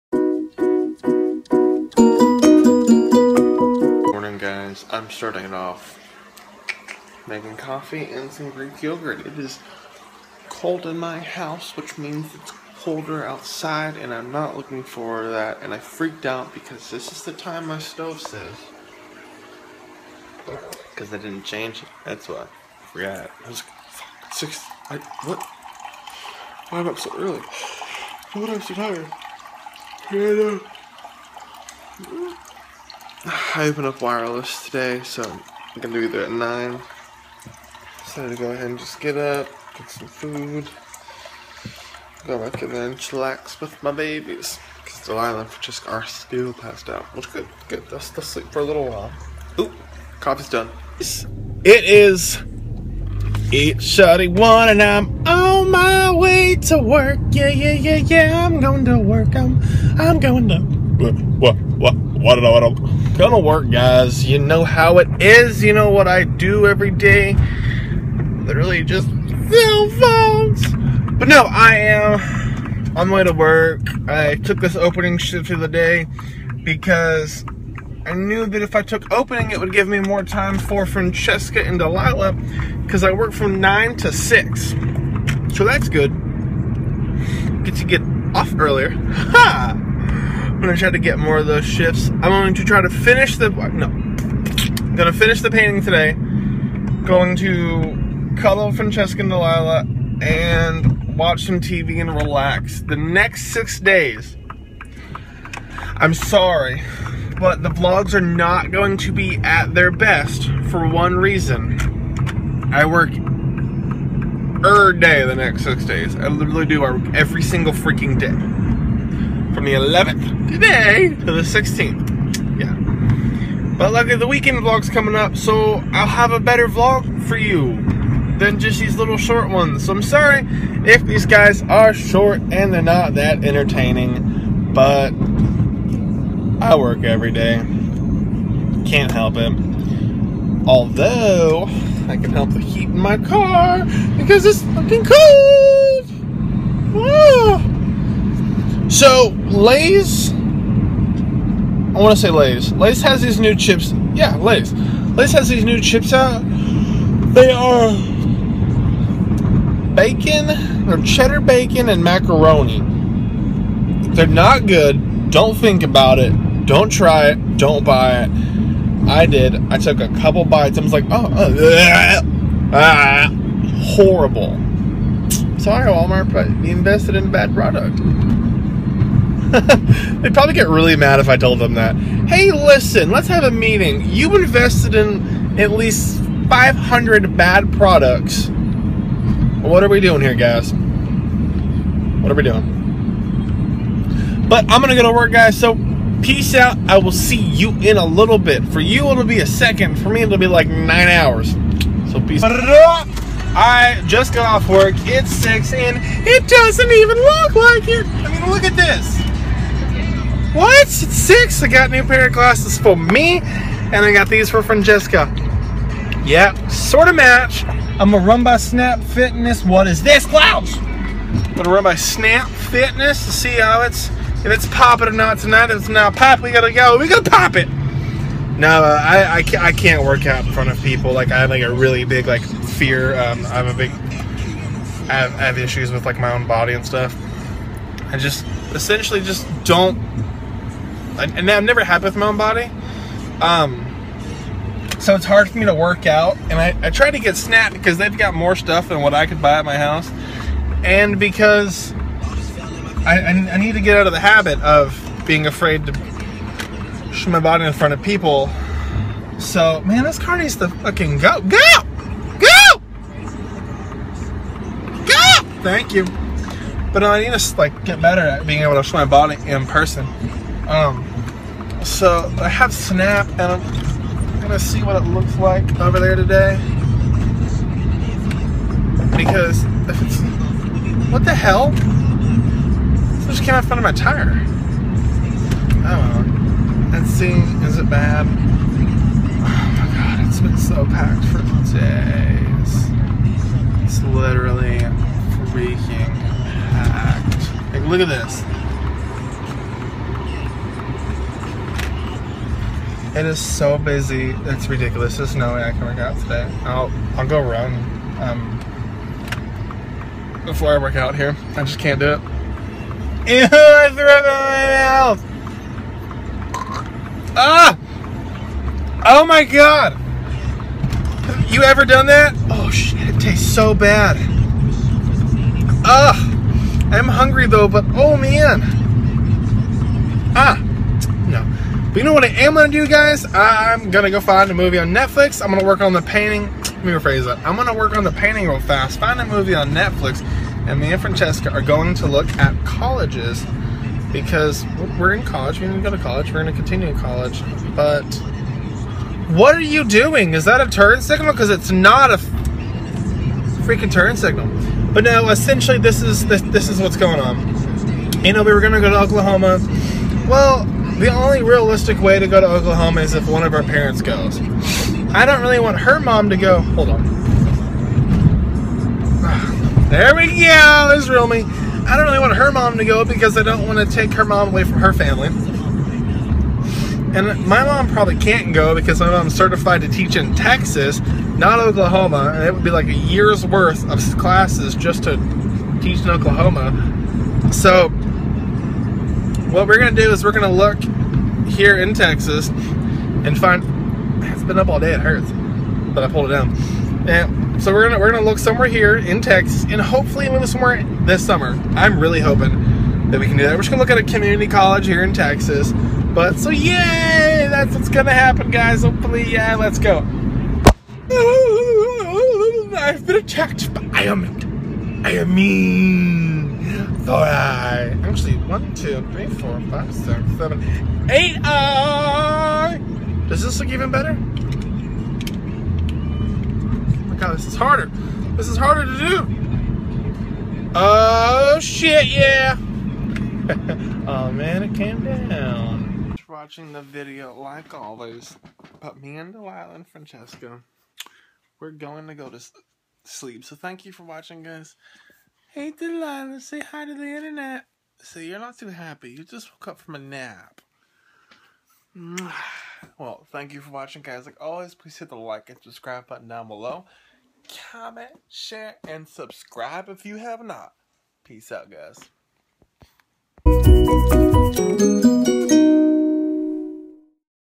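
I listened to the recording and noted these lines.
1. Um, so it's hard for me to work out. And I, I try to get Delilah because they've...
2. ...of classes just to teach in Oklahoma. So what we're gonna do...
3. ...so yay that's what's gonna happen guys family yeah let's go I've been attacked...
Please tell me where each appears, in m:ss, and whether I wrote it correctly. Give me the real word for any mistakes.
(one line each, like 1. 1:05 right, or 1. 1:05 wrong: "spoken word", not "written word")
1. 4:03 wrong: "Snap", not "Delilah"
2. 6:23 right
3. 6:46 wrong: "hopefully", not "family".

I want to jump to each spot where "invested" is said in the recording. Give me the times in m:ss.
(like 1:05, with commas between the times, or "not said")
2:56, 3:04.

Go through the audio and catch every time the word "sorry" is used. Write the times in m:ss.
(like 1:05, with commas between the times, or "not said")
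1:46, 2:10, 2:55.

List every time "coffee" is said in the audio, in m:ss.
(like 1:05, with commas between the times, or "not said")
0:07, 0:50.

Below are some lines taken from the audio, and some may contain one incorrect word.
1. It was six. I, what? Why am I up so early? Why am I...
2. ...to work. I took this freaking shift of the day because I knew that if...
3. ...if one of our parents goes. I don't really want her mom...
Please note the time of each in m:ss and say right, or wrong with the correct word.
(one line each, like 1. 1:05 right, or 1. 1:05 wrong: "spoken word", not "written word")
1. 0:23 right
2. 1:13 wrong: "opening", not "freaking"
3. 6:03 right.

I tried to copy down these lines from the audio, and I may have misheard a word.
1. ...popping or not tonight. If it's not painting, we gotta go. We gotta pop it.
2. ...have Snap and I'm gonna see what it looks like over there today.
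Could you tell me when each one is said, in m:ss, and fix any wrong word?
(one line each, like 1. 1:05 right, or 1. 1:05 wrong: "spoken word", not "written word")
1. 3:44 wrong: "popping", not "painting"
2. 4:32 right.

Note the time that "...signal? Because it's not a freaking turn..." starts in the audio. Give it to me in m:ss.
5:51.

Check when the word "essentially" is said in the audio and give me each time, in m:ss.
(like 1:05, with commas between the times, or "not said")
3:58, 5:55.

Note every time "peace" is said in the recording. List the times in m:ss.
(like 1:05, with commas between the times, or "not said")
3:16, 3:22, 7:41.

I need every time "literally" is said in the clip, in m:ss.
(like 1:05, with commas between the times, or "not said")
1:08, 1:56, 4:54.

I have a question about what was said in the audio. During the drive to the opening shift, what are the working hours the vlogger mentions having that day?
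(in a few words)
9 to 6.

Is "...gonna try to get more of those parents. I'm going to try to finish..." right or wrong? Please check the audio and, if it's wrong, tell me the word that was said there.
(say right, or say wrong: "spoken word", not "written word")
wrong: "shifts", not "parents".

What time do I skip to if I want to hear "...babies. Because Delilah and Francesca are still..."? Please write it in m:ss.
0:43.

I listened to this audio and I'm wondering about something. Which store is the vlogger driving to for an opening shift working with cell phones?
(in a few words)
Wireless.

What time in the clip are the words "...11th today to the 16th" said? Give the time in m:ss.
1:59.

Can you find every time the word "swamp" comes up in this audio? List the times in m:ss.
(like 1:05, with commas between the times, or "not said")
not said.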